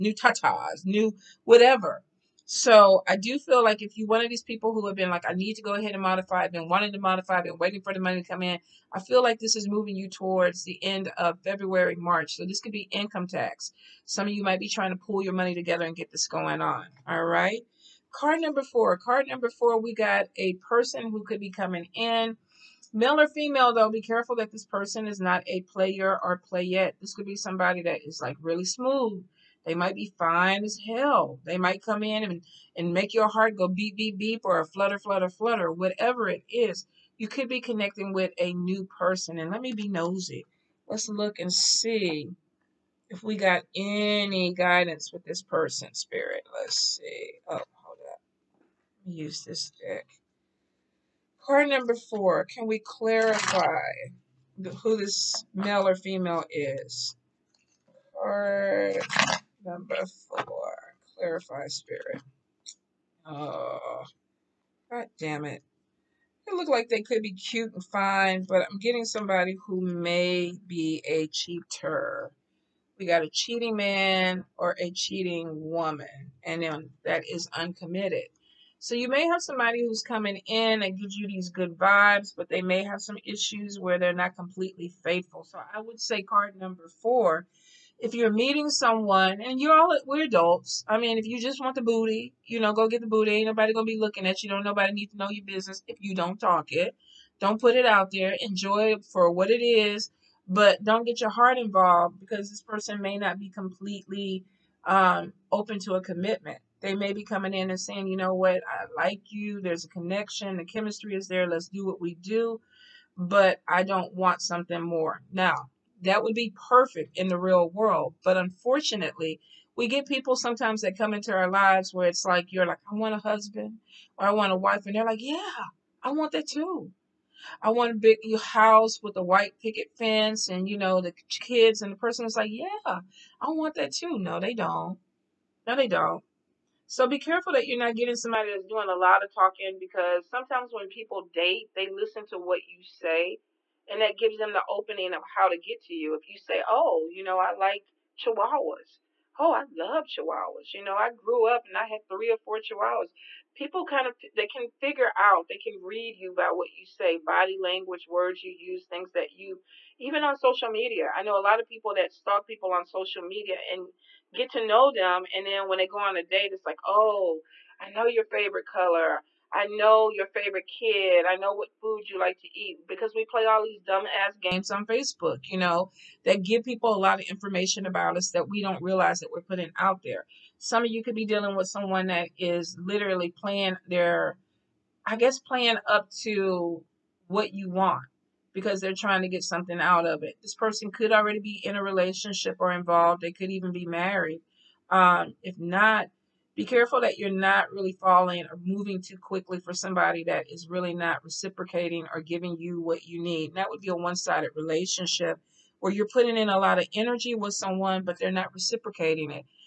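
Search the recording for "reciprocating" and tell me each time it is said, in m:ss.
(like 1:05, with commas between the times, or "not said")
3:21, 3:28.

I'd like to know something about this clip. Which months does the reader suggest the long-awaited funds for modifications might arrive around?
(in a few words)
end of February, March.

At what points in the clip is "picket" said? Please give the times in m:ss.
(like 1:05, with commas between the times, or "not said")
2:09.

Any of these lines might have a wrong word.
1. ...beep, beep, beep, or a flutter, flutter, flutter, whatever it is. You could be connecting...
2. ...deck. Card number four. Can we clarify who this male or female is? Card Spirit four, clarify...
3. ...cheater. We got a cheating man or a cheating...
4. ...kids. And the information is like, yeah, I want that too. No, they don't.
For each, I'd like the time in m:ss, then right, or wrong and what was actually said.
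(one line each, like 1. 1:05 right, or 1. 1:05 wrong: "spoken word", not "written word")
1. 0:33 right
2. 0:49 wrong: "Number", not "Spirit"
3. 1:11 right
4. 2:11 wrong: "person", not "information".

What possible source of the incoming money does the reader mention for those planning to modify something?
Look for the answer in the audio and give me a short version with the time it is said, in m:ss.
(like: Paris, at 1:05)
income tax, at 0:12.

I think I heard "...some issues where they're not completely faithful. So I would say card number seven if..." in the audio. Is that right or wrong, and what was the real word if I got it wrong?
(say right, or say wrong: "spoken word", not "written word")
wrong: "four", not "seven".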